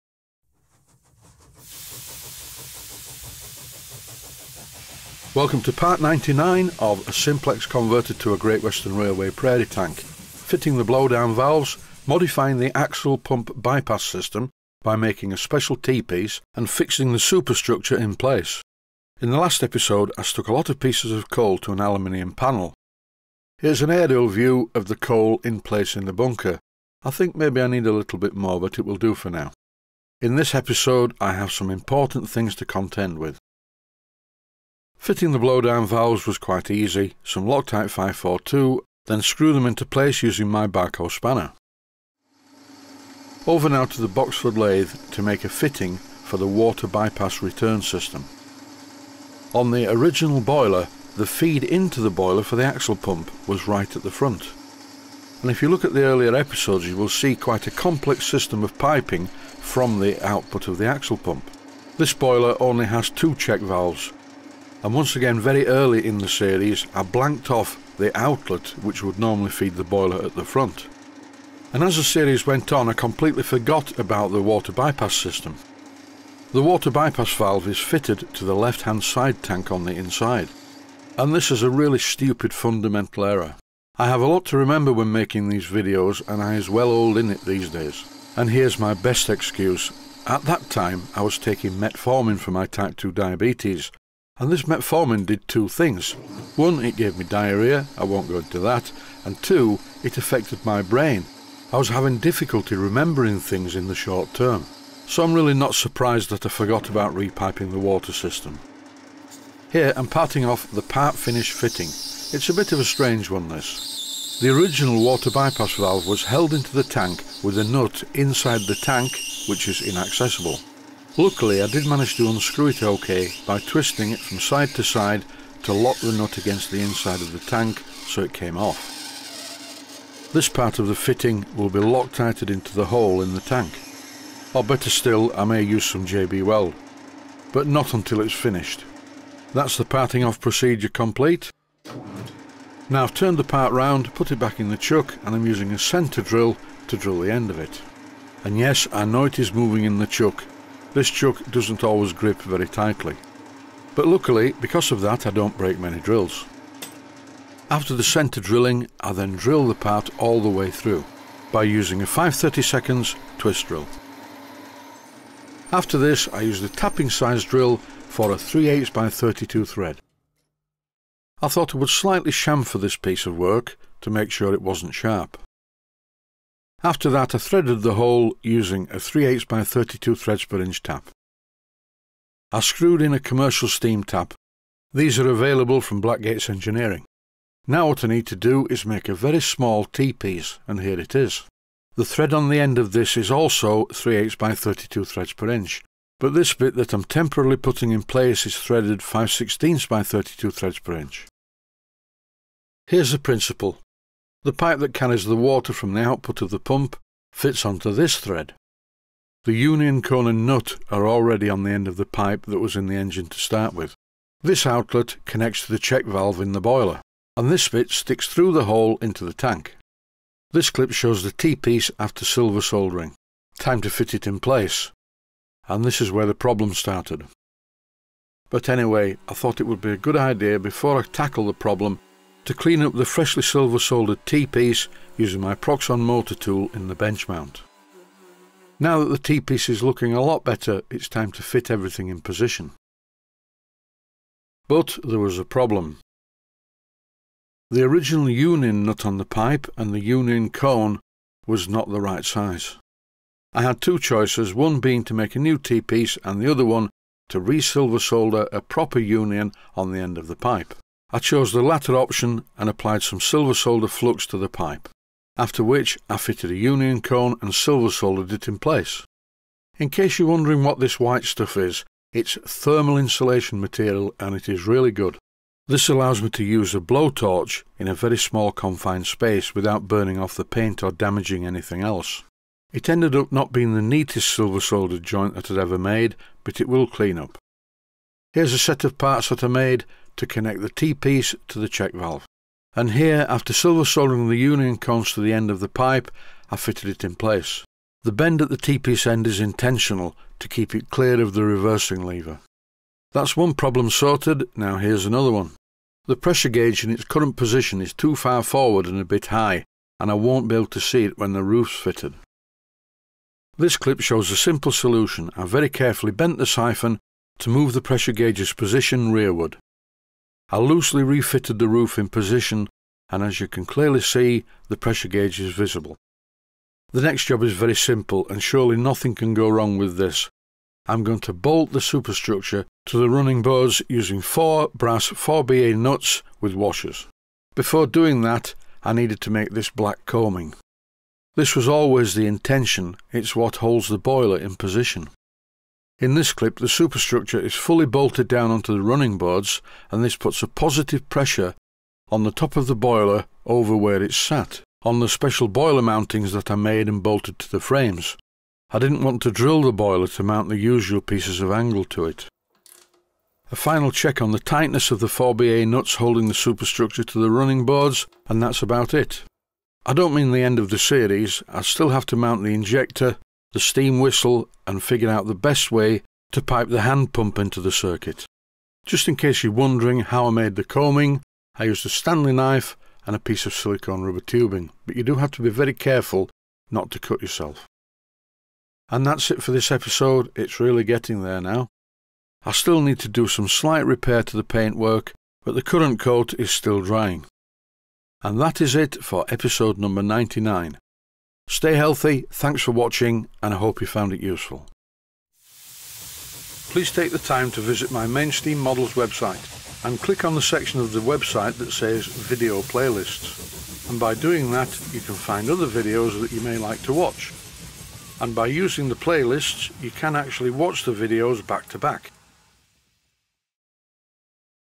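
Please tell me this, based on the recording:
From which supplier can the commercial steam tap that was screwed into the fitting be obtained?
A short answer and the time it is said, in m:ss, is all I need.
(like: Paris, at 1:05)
Blackgates Engineering, at 3:06.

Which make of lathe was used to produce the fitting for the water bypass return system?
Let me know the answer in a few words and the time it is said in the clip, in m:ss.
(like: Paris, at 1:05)
Boxford, at 0:44.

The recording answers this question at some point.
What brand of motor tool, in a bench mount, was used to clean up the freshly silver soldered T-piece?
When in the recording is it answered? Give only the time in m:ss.
3:55.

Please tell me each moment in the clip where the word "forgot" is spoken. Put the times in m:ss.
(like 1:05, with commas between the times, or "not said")
1:13, 1:46.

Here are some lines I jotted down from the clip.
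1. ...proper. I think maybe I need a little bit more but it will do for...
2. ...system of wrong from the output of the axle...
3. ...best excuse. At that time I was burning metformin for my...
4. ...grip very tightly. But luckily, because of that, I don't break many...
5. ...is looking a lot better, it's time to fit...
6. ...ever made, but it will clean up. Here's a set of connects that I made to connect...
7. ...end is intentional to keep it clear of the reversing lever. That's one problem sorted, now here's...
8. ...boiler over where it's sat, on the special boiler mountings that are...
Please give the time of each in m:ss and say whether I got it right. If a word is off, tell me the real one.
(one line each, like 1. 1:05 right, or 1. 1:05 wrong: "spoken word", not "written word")
1. 0:26 wrong: "bunker", not "proper"
2. 0:58 wrong: "piping", not "wrong"
3. 1:28 wrong: "taking", not "burning"
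4. 2:32 right
5. 3:59 right
6. 4:45 wrong: "parts", not "connects"
7. 4:59 right
8. 5:52 right.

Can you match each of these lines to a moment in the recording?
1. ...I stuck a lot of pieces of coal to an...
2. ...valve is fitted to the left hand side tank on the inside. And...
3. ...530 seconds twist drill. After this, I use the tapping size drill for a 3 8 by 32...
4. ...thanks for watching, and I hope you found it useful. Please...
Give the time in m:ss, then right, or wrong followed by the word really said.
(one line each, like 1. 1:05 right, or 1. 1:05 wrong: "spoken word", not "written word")
1. 0:20 right
2. 1:17 right
3. 2:42 right
4. 6:42 right.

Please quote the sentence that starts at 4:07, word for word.
The original union nut on the pipe and the union cone was not the right size.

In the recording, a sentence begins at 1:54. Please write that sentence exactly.
The original water bypass valve was held into the tank with a nut inside the tank which is inaccessible.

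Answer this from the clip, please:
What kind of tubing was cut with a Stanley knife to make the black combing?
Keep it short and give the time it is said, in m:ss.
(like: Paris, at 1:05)
silicone rubber tubing, at 6:23.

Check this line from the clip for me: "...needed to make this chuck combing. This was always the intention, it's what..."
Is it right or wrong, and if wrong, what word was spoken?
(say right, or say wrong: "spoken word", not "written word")
wrong: "black", not "chuck".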